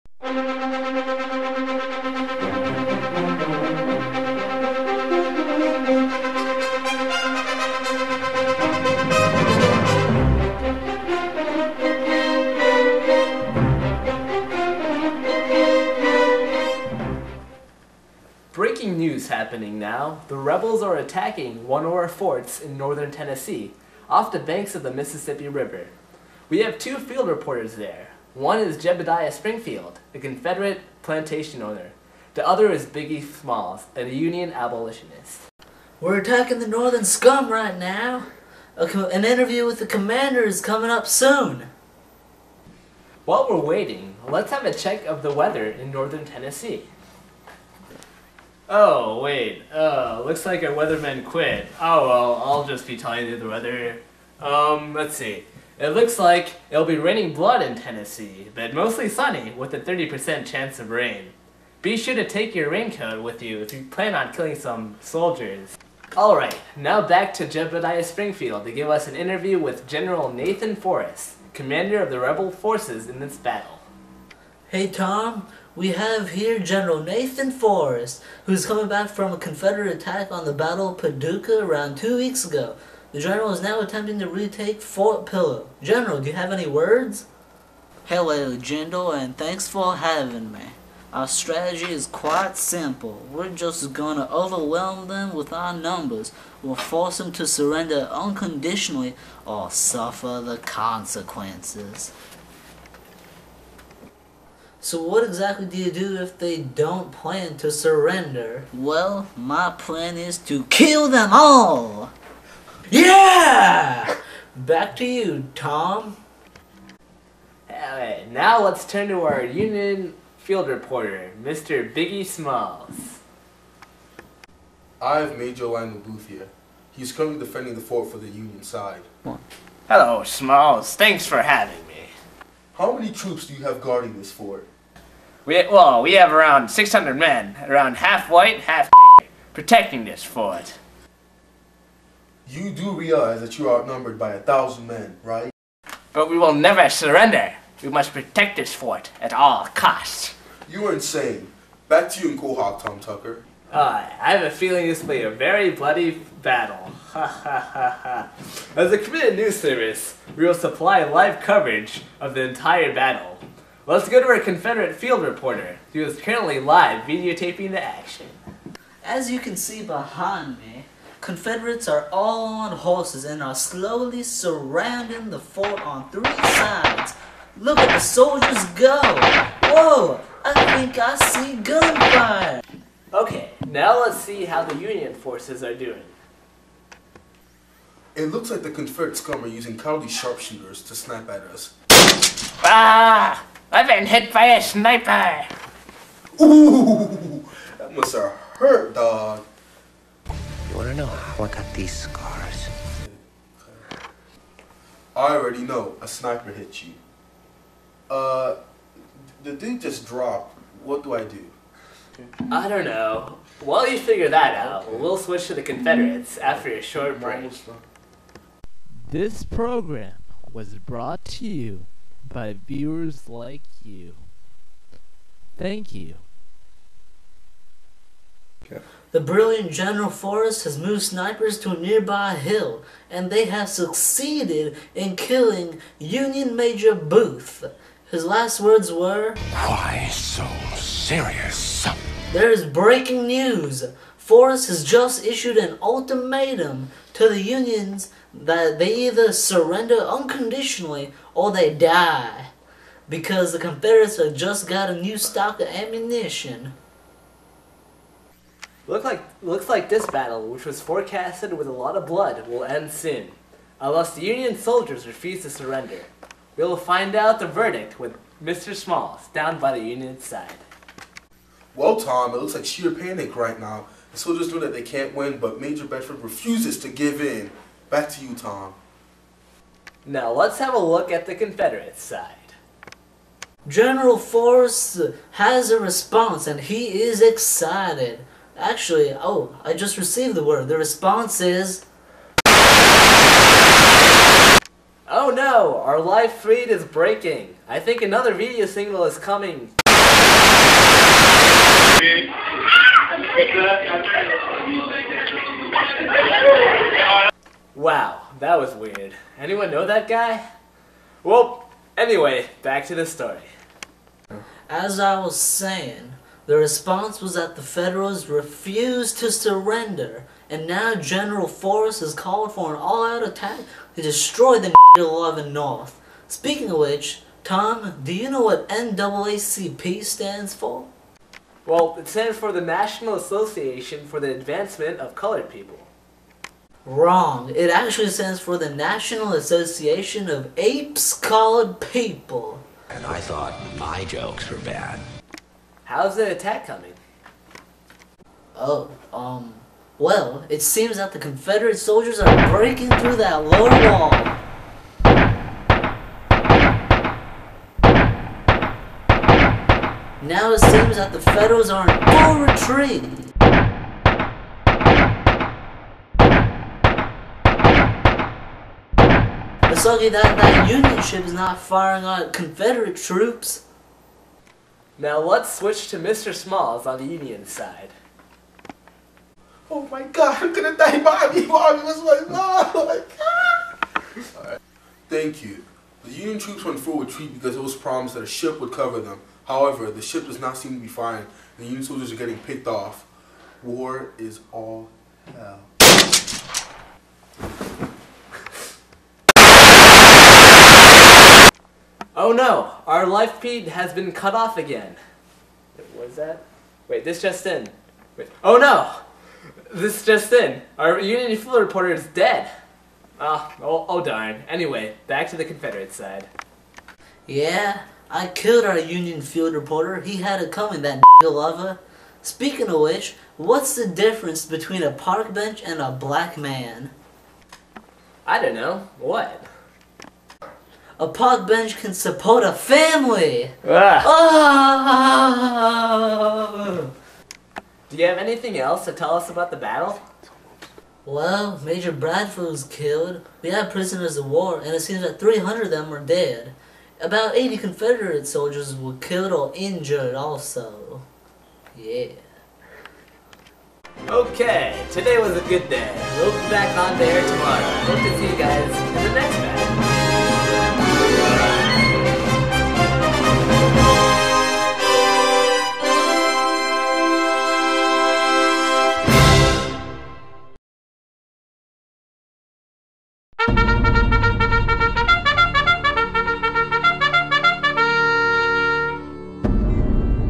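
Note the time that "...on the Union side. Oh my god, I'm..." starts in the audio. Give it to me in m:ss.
6:16.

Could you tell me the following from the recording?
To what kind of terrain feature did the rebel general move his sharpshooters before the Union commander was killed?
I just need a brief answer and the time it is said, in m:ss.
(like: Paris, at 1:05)
A nearby hill, at 3:51.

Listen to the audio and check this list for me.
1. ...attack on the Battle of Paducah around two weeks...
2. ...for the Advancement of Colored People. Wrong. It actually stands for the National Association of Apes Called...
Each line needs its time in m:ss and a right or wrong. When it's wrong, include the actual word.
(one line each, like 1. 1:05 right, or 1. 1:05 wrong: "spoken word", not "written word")
1. 1:19 right
2. 5:34 right.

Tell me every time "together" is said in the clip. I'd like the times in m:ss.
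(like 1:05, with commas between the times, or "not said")
not said.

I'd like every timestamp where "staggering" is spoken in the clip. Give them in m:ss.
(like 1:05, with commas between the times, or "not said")
not said.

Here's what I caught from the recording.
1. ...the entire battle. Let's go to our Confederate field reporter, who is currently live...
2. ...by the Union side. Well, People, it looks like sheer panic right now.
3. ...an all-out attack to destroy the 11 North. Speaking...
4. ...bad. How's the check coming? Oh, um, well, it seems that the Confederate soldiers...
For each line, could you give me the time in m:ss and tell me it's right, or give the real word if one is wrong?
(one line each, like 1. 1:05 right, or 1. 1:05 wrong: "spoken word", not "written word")
1. 2:42 right
2. 4:29 wrong: "Tom", not "People"
3. 5:22 right
4. 5:44 wrong: "attack", not "check".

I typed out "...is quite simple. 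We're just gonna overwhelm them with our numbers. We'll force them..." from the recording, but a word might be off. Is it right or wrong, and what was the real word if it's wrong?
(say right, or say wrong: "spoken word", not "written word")
right.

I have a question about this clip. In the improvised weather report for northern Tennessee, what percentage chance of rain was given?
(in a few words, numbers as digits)
30%.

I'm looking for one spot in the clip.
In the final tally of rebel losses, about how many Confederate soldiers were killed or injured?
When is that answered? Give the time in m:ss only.
7:27.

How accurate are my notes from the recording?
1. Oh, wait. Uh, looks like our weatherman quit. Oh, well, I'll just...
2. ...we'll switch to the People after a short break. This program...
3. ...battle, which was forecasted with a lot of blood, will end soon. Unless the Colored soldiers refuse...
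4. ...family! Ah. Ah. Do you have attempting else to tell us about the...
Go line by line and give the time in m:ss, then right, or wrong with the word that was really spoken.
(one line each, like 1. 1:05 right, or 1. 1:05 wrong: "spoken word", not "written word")
1. 0:48 right
2. 3:34 wrong: "Confederates", not "People"
3. 4:20 wrong: "Union", not "Colored"
4. 7:12 wrong: "anything", not "attempting".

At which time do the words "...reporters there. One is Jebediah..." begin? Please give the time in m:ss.
0:27.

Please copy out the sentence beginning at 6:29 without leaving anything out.
However, the ship does not seem to be firing, and the Union soldiers are getting picked off.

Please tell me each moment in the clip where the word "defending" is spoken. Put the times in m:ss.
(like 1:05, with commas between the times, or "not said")
2:07.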